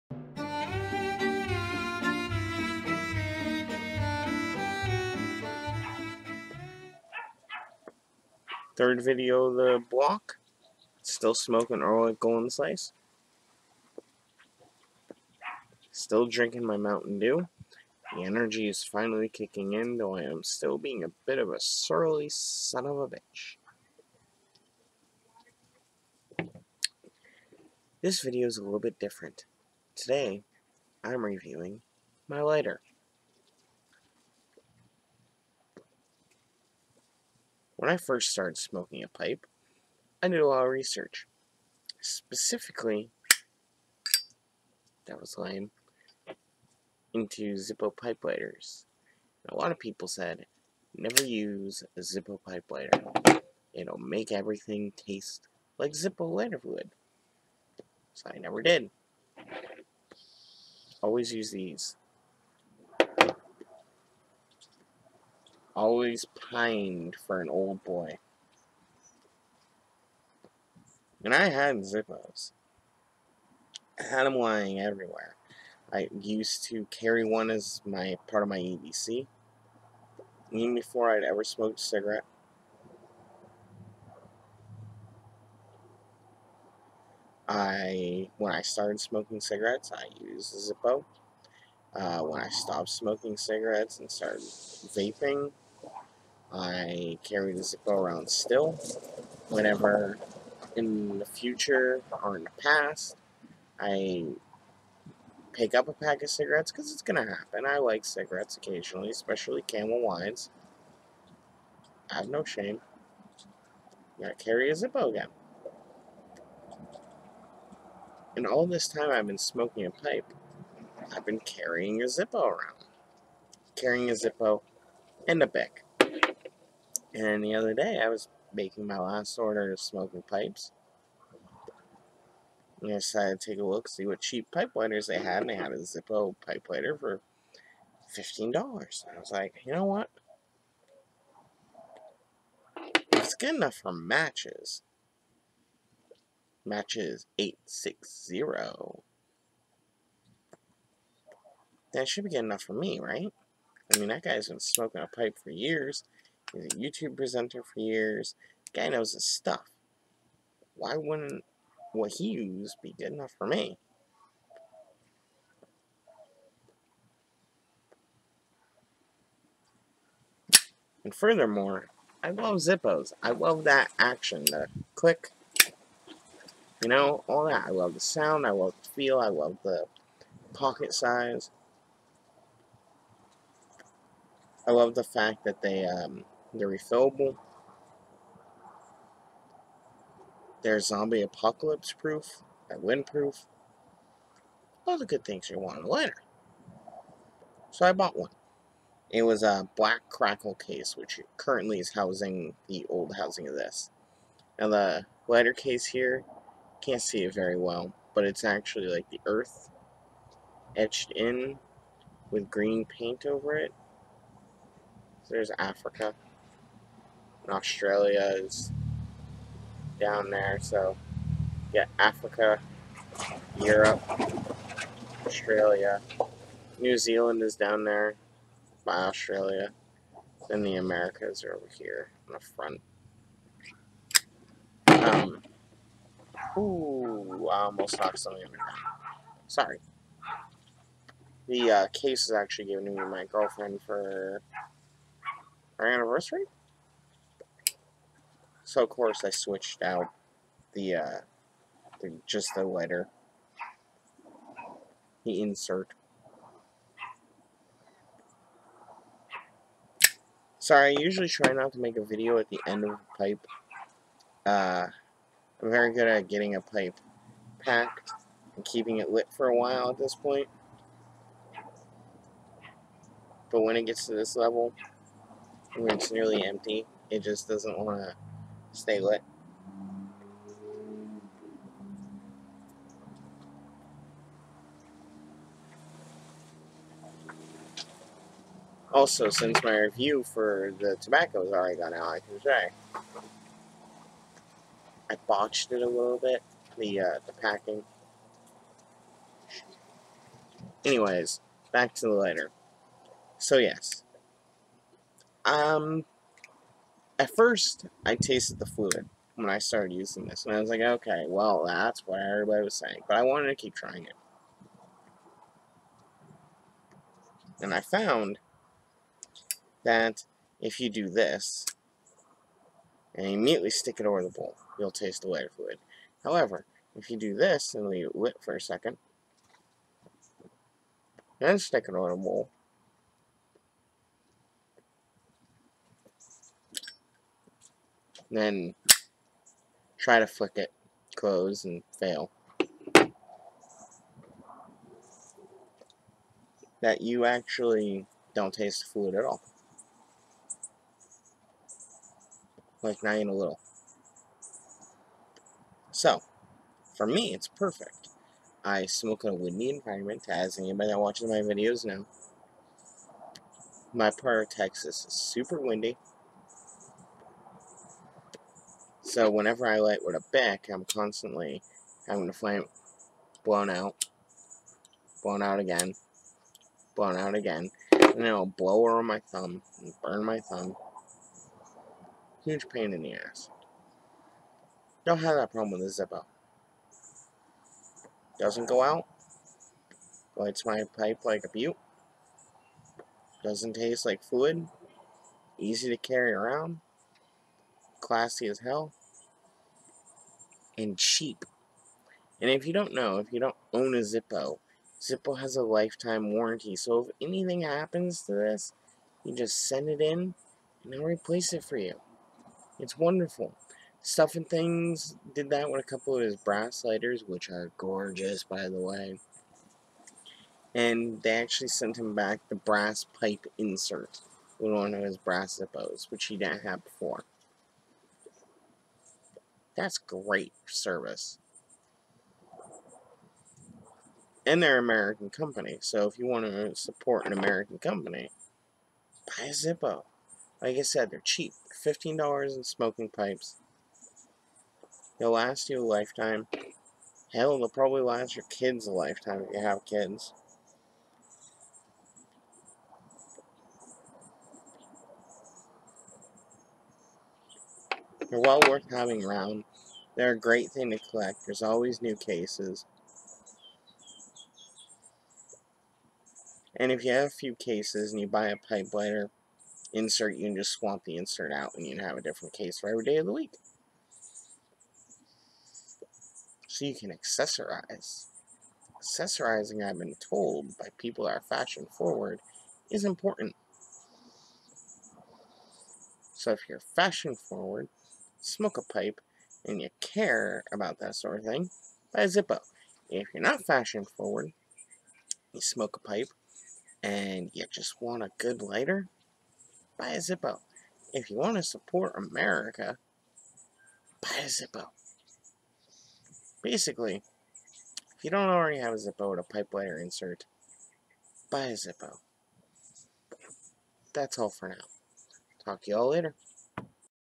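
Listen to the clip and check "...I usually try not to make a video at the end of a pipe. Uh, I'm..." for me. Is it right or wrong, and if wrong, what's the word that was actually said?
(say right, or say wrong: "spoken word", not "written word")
right.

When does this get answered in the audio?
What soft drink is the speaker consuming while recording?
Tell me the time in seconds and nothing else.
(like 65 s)
16 s.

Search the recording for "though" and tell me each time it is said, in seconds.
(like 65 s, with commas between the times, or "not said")
19 s.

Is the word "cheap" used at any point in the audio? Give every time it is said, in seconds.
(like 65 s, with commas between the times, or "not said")
134 s, 400 s, 441 s.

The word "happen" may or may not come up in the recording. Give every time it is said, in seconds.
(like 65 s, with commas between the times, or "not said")
107 s, 407 s.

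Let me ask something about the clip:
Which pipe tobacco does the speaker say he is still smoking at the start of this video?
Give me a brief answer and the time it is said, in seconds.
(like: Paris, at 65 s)
Orlik Golden Slice, at 11 s.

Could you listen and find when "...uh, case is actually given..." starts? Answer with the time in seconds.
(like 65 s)
241 s.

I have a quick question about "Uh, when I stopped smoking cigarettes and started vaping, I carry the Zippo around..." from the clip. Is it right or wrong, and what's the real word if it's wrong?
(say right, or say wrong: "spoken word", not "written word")
right.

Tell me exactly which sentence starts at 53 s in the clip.
It'll make everything taste like Zippo lighter fluid.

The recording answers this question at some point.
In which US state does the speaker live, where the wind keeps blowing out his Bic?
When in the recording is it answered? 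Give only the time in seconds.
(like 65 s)
364 s.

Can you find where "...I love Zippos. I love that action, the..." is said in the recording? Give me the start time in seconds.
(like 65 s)
172 s.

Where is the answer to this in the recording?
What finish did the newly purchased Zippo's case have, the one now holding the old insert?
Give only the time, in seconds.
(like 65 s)
199 s.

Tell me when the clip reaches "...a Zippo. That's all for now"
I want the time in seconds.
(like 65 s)
511 s.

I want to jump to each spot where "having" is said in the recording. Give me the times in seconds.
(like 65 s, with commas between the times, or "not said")
372 s, 458 s.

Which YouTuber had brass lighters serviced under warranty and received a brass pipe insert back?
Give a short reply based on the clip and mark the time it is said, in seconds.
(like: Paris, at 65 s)
Stuff and Things, at 414 s.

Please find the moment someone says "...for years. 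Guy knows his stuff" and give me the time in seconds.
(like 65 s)
157 s.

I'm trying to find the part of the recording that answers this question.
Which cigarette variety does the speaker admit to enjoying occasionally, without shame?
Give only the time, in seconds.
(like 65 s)
109 s.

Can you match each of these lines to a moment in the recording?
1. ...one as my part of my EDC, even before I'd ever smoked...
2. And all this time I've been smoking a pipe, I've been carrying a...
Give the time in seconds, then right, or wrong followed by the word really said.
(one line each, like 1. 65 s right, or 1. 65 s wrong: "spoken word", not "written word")
1. 77 s right
2. 118 s right.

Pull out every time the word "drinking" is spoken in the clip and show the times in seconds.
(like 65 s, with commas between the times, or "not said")
16 s.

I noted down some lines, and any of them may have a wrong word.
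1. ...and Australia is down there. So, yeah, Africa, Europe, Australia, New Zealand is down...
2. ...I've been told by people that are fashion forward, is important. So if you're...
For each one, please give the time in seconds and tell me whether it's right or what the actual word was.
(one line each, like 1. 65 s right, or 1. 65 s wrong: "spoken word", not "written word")
1. 217 s right
2. 479 s right.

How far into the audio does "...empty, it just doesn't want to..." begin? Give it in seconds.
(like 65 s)
276 s.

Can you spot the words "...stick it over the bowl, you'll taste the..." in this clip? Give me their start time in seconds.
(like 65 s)
323 s.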